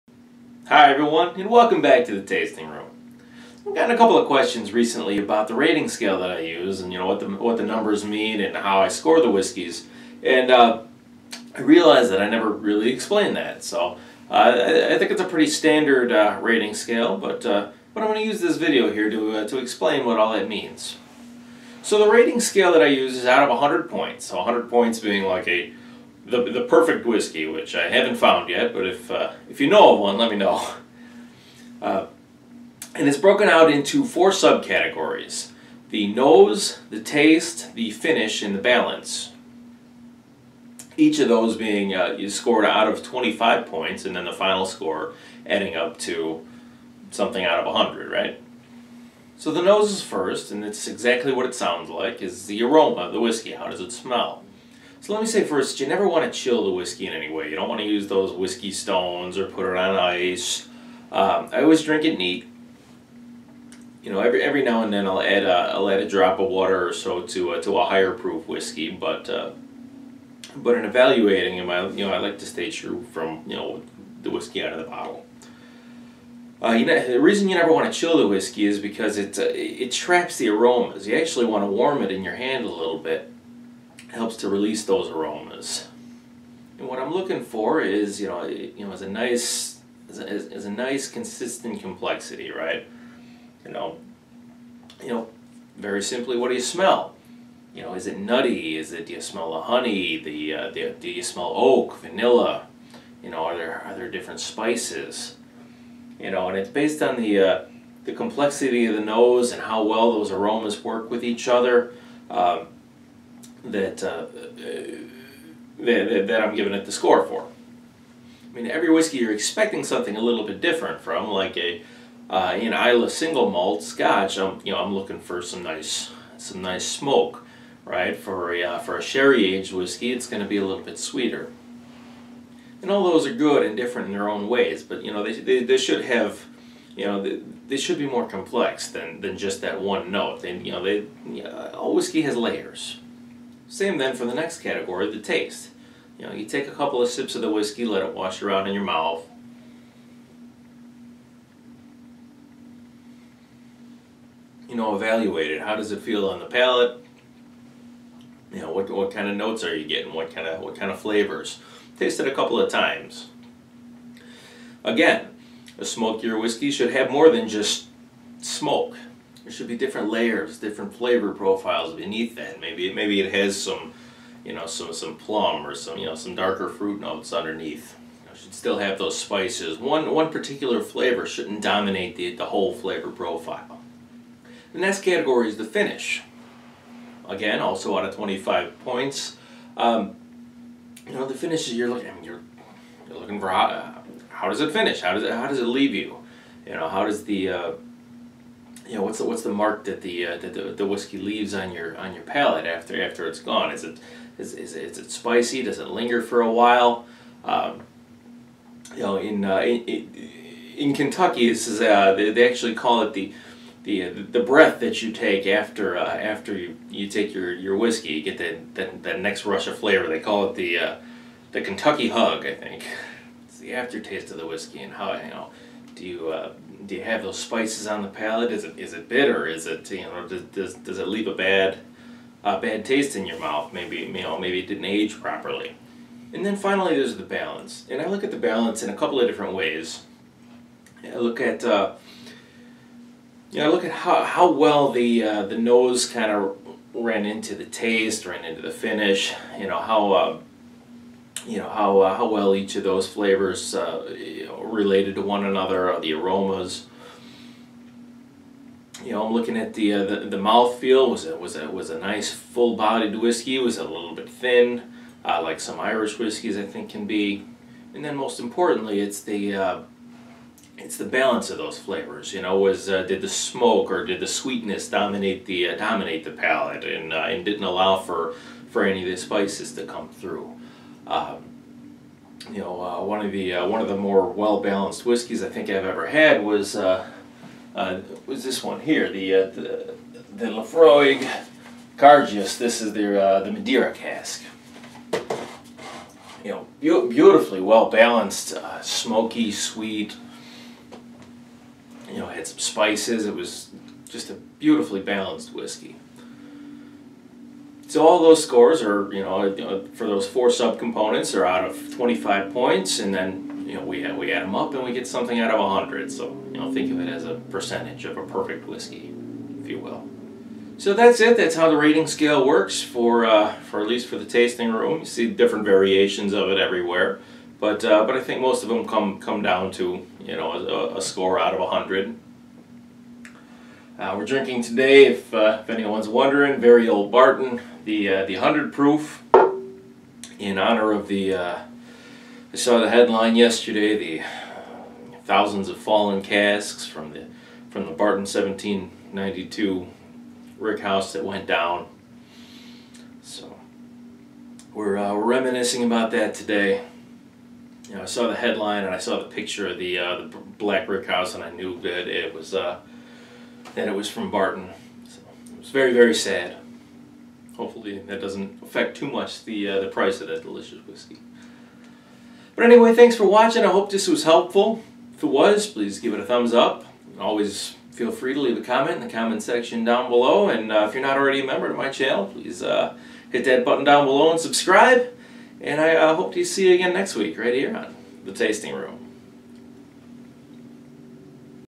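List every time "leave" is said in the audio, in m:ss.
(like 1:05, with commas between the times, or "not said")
3:15, 3:21, 3:51, 6:18.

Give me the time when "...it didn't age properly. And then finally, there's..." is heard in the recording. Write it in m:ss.
3:54.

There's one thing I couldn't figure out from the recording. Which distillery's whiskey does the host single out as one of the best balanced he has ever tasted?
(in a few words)
Laphroaig.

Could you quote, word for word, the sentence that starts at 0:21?
So the rating scale that I use is out of 100 points.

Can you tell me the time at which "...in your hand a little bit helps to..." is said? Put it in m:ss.
1:22.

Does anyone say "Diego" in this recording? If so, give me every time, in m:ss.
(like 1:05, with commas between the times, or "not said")
not said.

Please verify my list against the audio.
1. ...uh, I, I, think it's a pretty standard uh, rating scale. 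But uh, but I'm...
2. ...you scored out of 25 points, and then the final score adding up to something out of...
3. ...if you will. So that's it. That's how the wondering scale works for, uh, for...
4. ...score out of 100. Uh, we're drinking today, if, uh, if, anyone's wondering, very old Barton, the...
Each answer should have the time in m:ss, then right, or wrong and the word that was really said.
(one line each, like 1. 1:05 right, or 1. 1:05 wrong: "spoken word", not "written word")
1. 0:14 right
2. 0:42 right
3. 5:19 wrong: "rating", not "wondering"
4. 5:31 right.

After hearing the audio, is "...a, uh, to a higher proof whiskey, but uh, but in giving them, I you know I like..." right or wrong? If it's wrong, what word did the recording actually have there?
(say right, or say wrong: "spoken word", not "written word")
wrong: "evaluating", not "giving".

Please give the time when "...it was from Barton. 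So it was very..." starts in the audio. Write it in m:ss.
6:03.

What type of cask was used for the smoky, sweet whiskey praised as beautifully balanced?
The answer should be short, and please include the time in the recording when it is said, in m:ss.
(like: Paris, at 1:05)
Madeira, at 4:53.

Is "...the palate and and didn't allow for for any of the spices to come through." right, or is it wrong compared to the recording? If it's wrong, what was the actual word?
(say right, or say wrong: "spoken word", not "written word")
right.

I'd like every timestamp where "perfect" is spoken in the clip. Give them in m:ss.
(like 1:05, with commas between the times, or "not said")
0:26, 5:18.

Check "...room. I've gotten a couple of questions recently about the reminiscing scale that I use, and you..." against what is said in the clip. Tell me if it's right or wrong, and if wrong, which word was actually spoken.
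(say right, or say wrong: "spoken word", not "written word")
wrong: "rating", not "reminiscing".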